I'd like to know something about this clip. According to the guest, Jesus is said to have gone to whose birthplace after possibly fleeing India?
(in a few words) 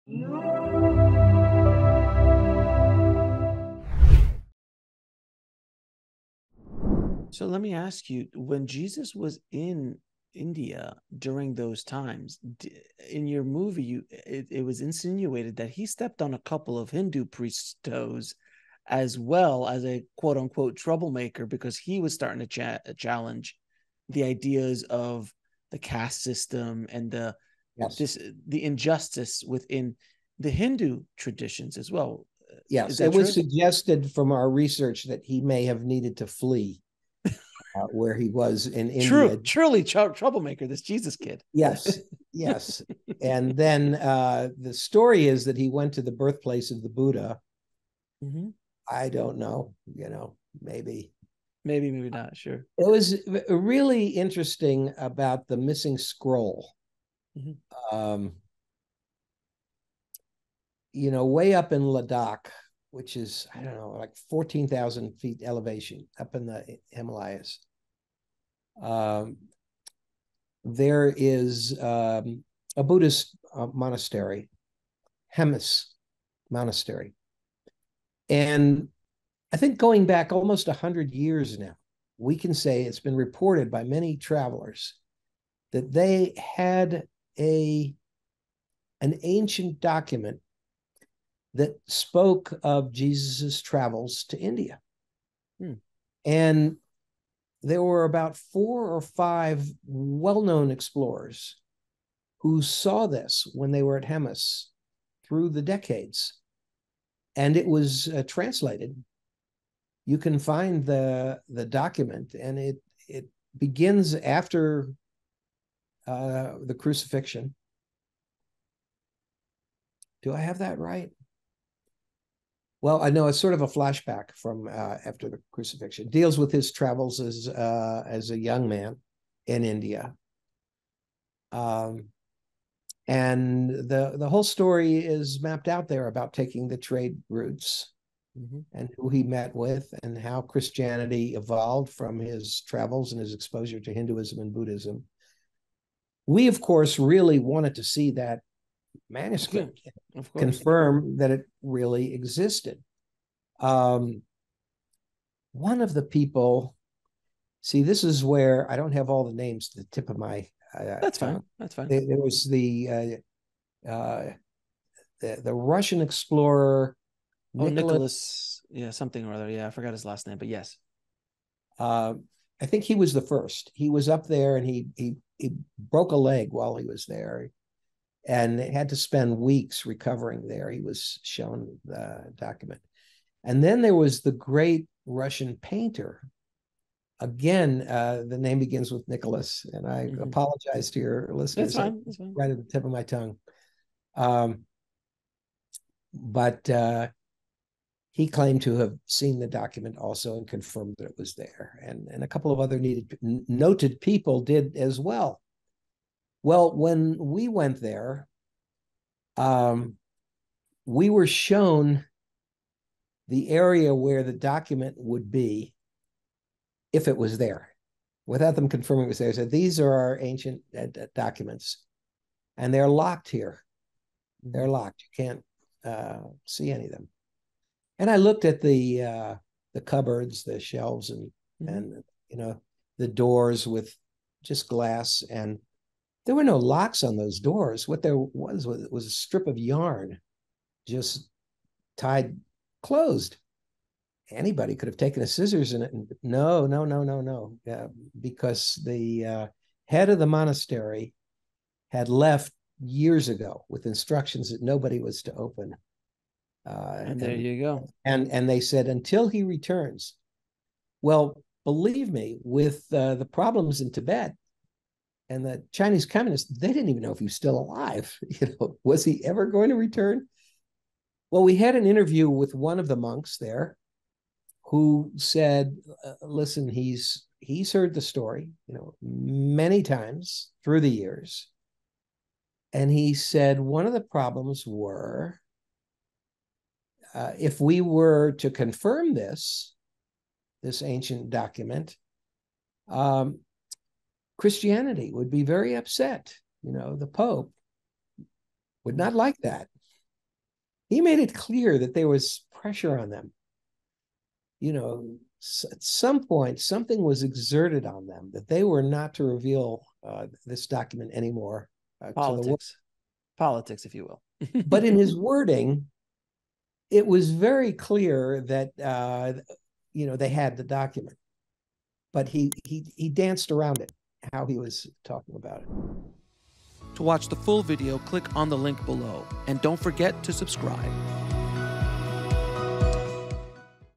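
the Buddha.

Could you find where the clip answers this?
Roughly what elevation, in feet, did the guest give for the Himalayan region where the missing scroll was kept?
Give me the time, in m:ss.
1:04.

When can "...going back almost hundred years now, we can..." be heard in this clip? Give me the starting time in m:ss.
1:19.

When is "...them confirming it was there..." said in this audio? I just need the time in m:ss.
3:38.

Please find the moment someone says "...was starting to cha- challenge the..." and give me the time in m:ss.
0:22.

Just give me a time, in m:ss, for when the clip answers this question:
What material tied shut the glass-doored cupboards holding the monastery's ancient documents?
3:59.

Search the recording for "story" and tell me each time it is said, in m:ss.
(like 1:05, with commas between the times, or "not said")
0:44, 2:14, 4:38.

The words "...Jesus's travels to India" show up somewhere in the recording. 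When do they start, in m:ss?
1:32.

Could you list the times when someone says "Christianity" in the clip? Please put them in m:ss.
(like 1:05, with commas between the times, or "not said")
2:20, 4:54.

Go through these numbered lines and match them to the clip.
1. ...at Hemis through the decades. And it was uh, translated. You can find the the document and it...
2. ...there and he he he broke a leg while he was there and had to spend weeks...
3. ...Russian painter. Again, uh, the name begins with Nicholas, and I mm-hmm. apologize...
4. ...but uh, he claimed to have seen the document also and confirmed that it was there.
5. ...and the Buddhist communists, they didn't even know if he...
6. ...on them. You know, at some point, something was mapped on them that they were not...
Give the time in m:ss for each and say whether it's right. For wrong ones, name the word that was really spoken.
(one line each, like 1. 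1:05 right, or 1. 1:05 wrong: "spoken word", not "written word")
1. 1:43 right
2. 2:54 right
3. 3:05 right
4. 3:16 right
5. 4:25 wrong: "Chinese", not "Buddhist"
6. 5:02 wrong: "exerted", not "mapped".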